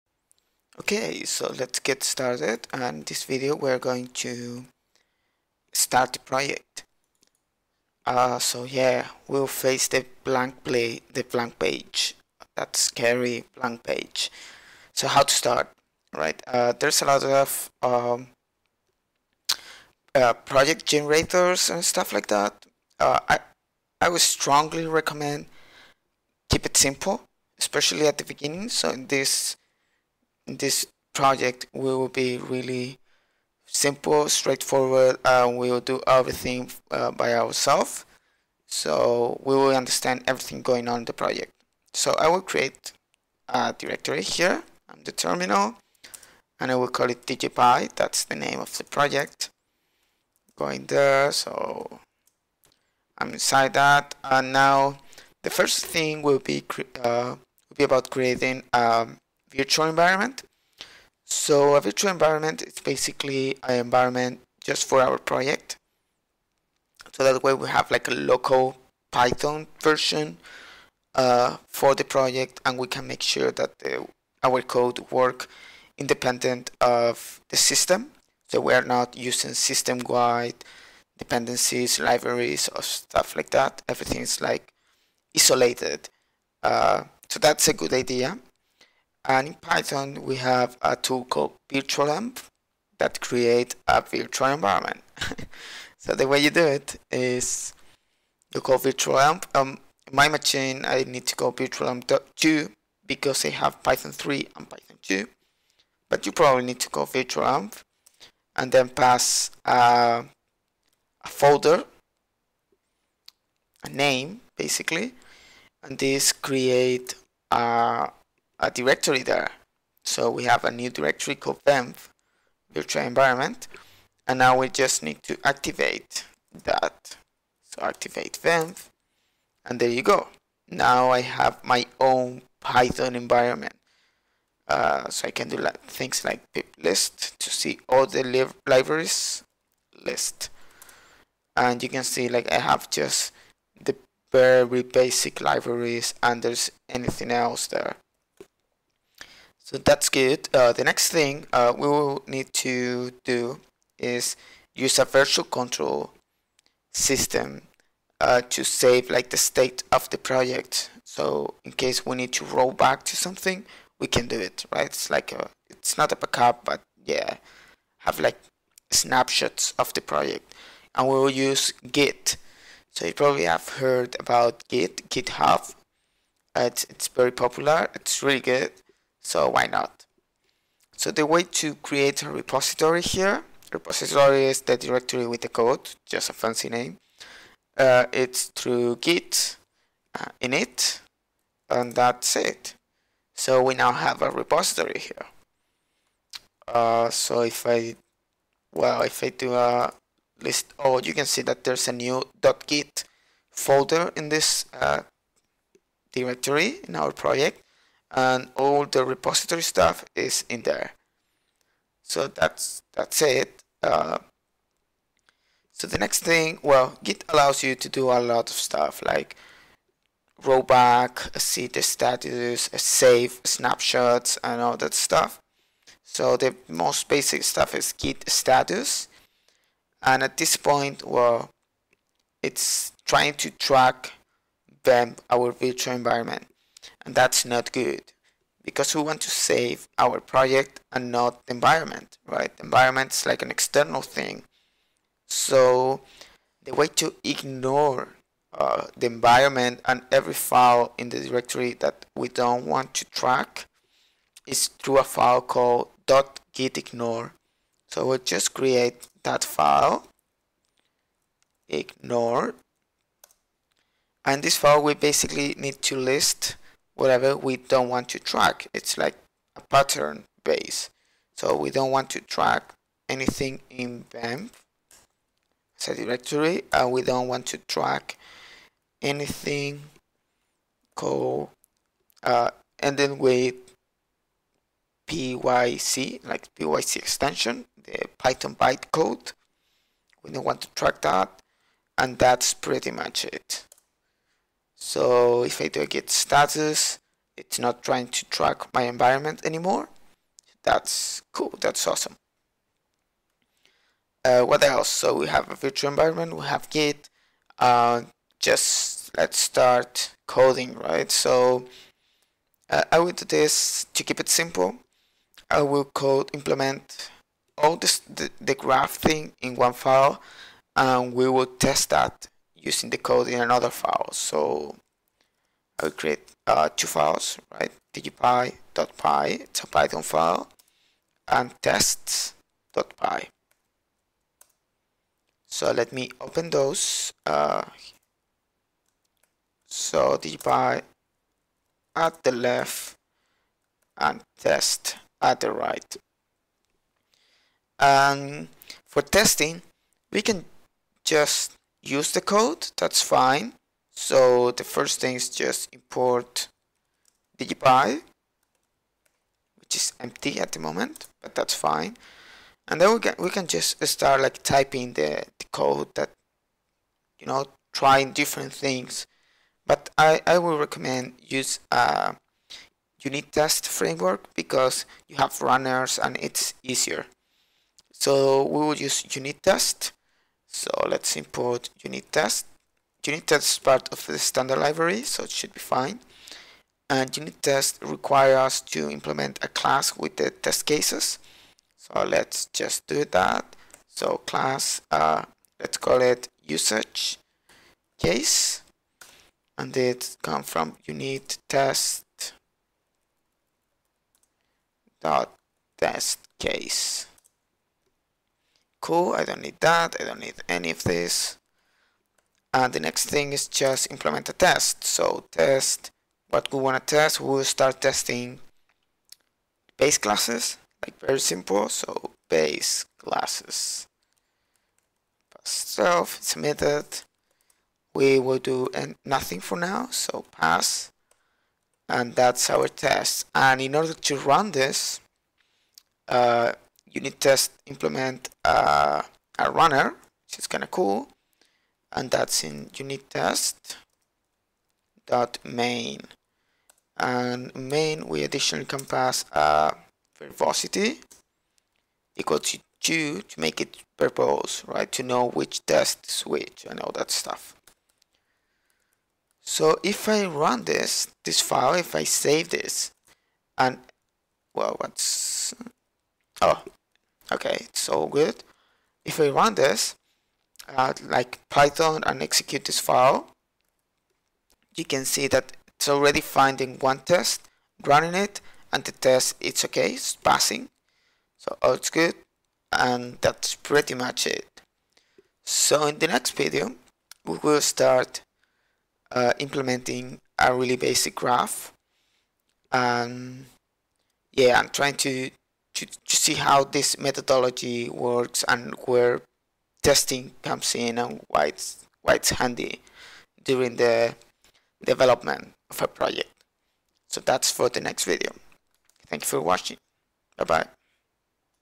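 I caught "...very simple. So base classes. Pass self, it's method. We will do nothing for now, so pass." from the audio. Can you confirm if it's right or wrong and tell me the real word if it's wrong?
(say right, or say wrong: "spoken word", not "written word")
right.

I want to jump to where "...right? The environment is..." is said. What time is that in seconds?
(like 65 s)
242 s.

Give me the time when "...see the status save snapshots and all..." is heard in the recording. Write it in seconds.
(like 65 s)
221 s.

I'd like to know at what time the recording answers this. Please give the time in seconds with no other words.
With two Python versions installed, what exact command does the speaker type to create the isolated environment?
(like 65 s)
101 s.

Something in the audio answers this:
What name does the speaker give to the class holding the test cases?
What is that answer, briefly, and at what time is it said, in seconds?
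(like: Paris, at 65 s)
usage case, at 396 s.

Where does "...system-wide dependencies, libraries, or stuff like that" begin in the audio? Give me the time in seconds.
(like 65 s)
79 s.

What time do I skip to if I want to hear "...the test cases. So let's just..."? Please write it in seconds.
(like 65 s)
390 s.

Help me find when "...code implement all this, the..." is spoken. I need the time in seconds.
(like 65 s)
315 s.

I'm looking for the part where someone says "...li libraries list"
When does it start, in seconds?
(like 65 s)
138 s.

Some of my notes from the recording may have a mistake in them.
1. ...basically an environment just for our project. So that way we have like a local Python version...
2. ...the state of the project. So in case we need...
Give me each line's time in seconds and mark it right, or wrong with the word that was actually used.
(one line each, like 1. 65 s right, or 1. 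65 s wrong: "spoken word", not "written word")
1. 62 s right
2. 159 s right.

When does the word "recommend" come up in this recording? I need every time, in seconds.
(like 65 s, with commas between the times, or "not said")
24 s, 370 s.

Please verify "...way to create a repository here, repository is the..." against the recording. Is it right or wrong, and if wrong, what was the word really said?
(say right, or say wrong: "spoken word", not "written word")
right.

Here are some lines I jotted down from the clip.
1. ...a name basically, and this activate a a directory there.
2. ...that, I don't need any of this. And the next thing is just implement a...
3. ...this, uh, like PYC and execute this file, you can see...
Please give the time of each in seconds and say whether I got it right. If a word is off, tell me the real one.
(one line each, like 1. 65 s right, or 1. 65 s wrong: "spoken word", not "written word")
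1. 113 s wrong: "create", not "activate"
2. 409 s right
3. 469 s wrong: "Python", not "PYC".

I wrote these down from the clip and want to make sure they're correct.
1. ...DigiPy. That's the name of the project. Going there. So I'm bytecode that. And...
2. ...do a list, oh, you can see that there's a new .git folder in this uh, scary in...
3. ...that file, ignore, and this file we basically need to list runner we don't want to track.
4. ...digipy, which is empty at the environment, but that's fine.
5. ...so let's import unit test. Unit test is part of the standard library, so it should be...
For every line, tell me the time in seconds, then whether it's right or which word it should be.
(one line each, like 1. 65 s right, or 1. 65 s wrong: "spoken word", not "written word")
1. 47 s wrong: "inside", not "bytecode"
2. 199 s wrong: "directory", not "scary"
3. 259 s wrong: "whatever", not "runner"
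4. 357 s wrong: "moment", not "environment"
5. 380 s right.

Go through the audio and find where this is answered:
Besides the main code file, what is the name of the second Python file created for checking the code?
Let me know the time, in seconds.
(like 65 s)
331 s.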